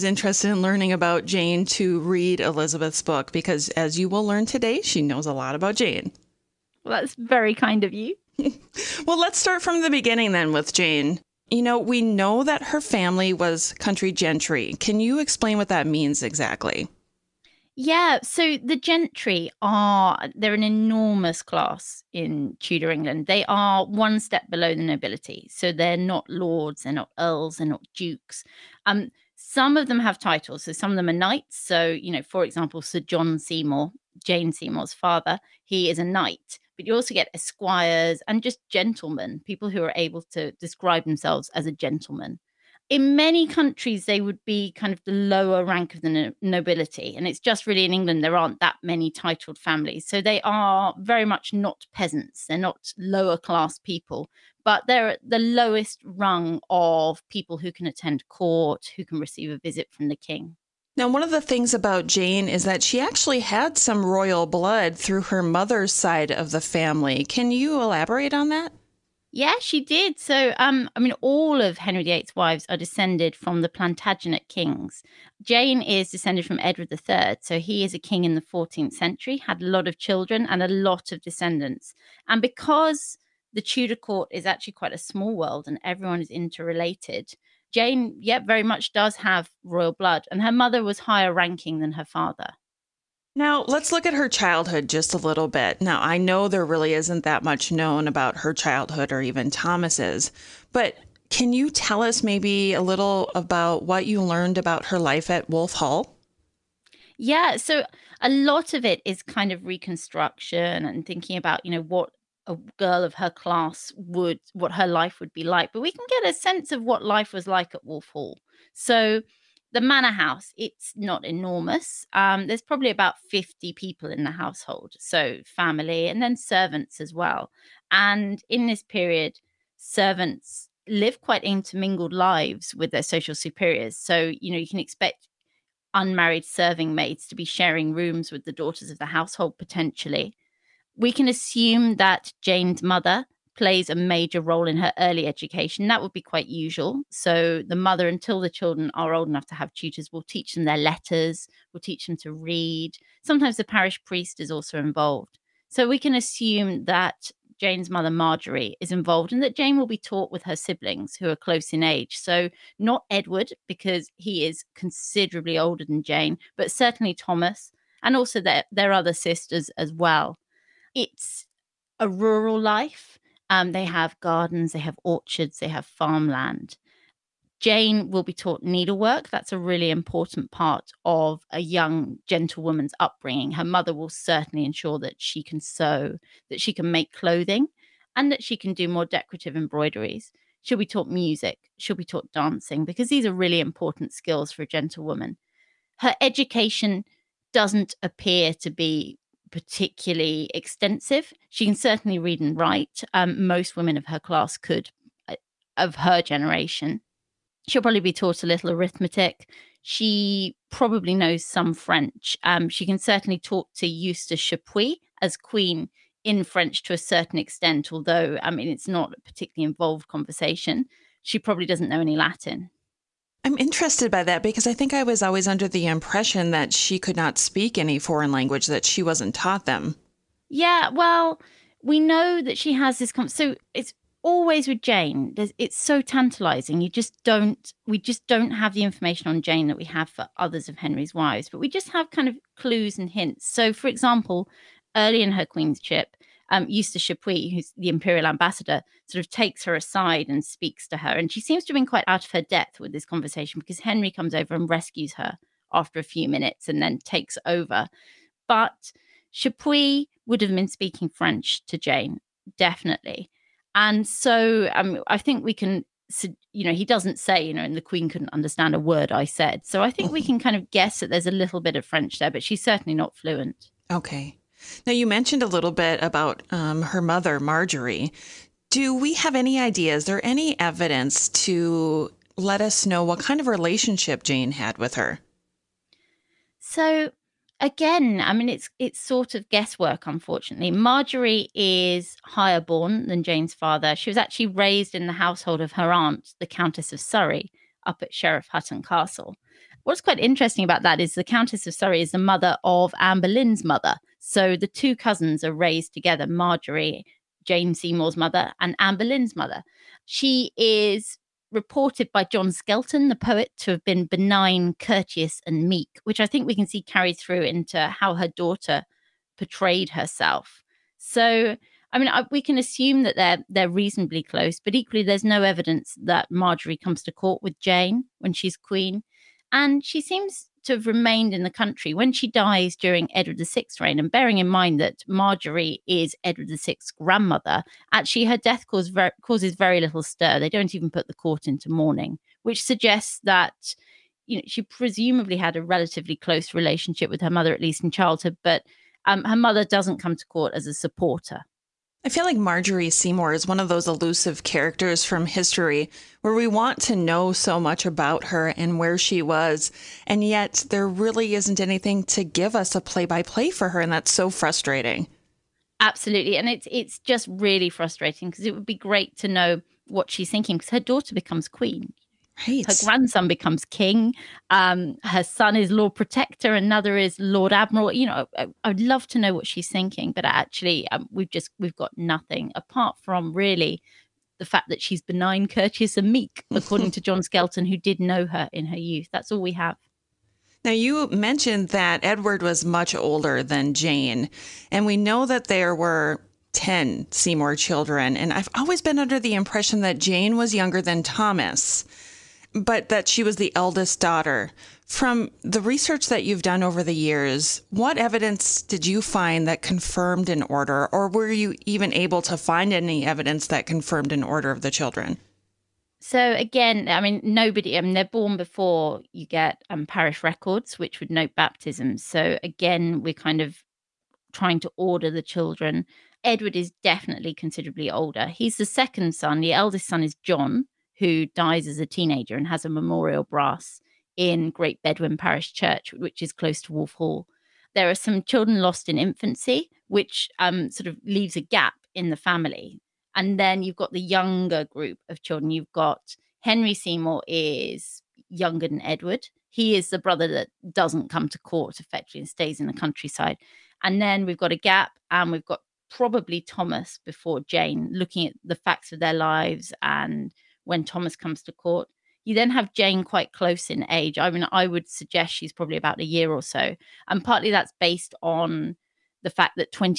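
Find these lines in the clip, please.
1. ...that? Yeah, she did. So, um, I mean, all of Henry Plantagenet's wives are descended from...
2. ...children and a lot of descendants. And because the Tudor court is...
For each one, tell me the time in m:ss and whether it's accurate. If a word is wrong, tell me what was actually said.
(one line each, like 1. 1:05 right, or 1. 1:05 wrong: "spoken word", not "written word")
1. 1:08 wrong: "VIII", not "Plantagenet"
2. 1:19 right.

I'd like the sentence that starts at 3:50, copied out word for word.
Yeah, well, we know that she has this.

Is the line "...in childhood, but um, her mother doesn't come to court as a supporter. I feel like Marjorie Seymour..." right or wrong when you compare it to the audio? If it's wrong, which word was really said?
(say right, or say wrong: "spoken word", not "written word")
right.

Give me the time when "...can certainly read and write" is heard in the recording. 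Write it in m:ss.
3:21.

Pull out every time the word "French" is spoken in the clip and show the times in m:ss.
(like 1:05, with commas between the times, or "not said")
3:31, 3:36, 4:21, 4:31.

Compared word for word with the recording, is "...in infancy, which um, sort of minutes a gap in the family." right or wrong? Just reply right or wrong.
wrong.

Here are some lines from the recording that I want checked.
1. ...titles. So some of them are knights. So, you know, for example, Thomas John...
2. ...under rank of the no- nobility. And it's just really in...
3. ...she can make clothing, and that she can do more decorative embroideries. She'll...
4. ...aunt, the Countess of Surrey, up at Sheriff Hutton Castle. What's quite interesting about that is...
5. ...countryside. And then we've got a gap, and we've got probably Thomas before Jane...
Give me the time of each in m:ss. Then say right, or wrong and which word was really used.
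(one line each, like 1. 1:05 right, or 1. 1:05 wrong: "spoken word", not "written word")
1. 0:30 wrong: "Sir", not "Thomas"
2. 0:45 wrong: "lower", not "under"
3. 3:06 right
4. 4:55 right
5. 7:32 right.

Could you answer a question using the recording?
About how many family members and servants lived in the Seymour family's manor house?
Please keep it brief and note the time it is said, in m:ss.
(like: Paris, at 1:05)
50, at 2:02.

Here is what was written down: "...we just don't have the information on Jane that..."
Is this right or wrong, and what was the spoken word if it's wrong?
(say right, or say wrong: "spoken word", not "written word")
right.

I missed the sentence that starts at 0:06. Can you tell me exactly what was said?
Well, that's very kind of you.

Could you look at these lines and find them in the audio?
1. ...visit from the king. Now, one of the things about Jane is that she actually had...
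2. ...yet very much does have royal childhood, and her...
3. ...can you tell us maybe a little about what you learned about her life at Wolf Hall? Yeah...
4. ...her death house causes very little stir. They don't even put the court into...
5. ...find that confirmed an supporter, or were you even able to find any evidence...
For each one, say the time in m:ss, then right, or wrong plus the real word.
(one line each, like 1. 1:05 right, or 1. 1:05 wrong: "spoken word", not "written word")
1. 0:59 right
2. 1:28 wrong: "blood", not "childhood"
3. 1:41 right
4. 5:38 wrong: "cause", not "house"
5. 6:49 wrong: "order", not "supporter".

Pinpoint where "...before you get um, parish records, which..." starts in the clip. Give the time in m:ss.
6:58.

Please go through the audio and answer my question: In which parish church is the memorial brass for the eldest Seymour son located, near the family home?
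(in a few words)
Great Bedwyn Parish Church.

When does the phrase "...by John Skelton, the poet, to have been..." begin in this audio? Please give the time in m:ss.
5:12.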